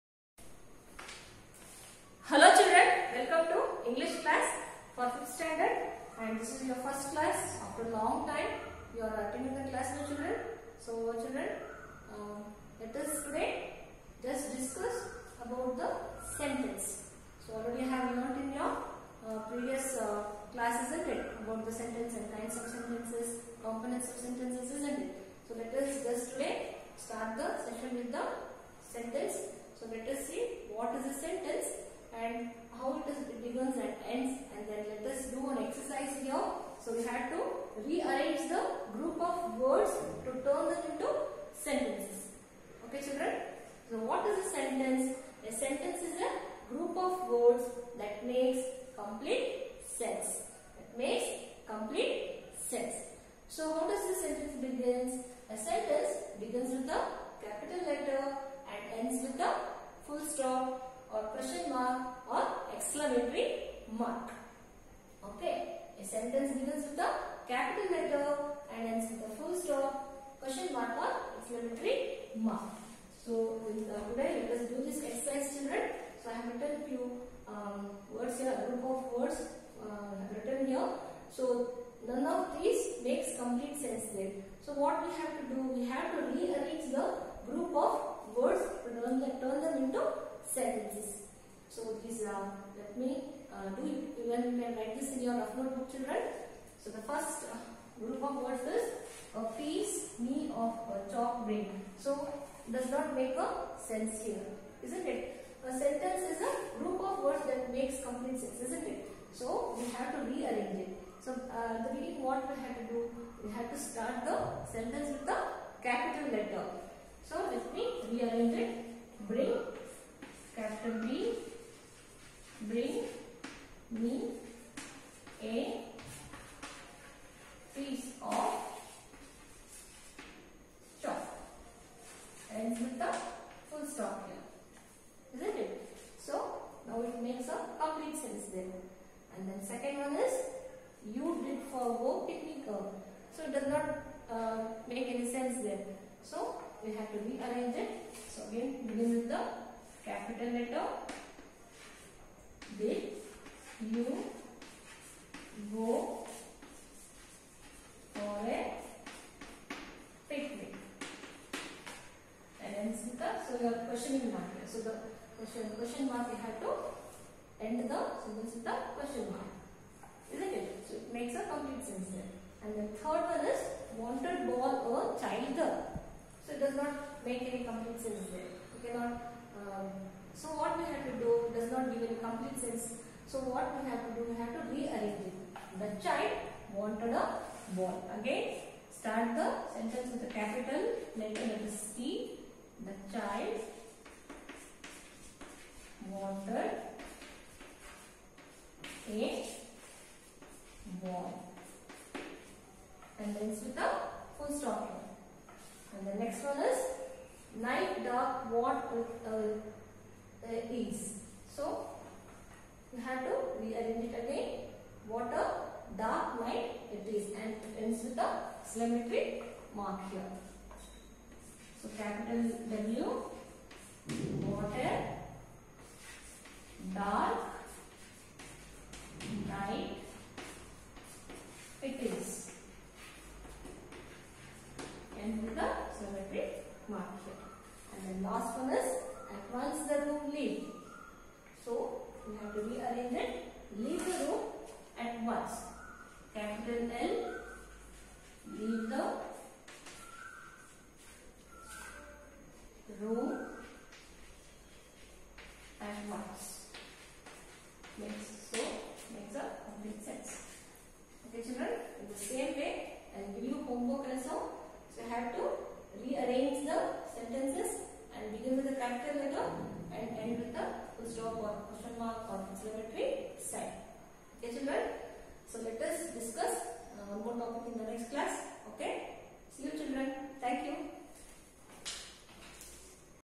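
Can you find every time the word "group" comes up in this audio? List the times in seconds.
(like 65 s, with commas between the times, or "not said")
46 s, 78 s, 87 s, 98 s, 106 s.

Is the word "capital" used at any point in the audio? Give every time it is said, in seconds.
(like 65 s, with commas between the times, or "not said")
57 s, 67 s, 115 s, 120 s, 150 s, 190 s, 221 s.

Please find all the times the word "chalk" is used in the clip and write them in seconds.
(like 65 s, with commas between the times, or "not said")
101 s.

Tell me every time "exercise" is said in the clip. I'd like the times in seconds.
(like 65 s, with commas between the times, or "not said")
75 s.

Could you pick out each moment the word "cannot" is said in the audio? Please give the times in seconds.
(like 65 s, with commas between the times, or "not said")
178 s.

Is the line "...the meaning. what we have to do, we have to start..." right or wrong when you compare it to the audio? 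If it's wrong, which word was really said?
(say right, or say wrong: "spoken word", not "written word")
right.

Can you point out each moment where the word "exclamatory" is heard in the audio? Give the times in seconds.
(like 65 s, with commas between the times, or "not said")
62 s, 71 s.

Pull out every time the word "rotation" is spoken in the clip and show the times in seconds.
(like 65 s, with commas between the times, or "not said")
not said.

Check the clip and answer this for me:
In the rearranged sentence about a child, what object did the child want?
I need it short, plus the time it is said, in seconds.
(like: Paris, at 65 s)
a ball, at 187 s.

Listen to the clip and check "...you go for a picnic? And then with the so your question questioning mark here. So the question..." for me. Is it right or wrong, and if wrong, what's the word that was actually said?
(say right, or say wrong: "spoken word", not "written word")
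right.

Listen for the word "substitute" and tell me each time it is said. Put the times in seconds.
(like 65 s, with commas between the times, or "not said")
not said.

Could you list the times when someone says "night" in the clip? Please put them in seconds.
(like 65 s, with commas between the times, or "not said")
207 s, 216 s.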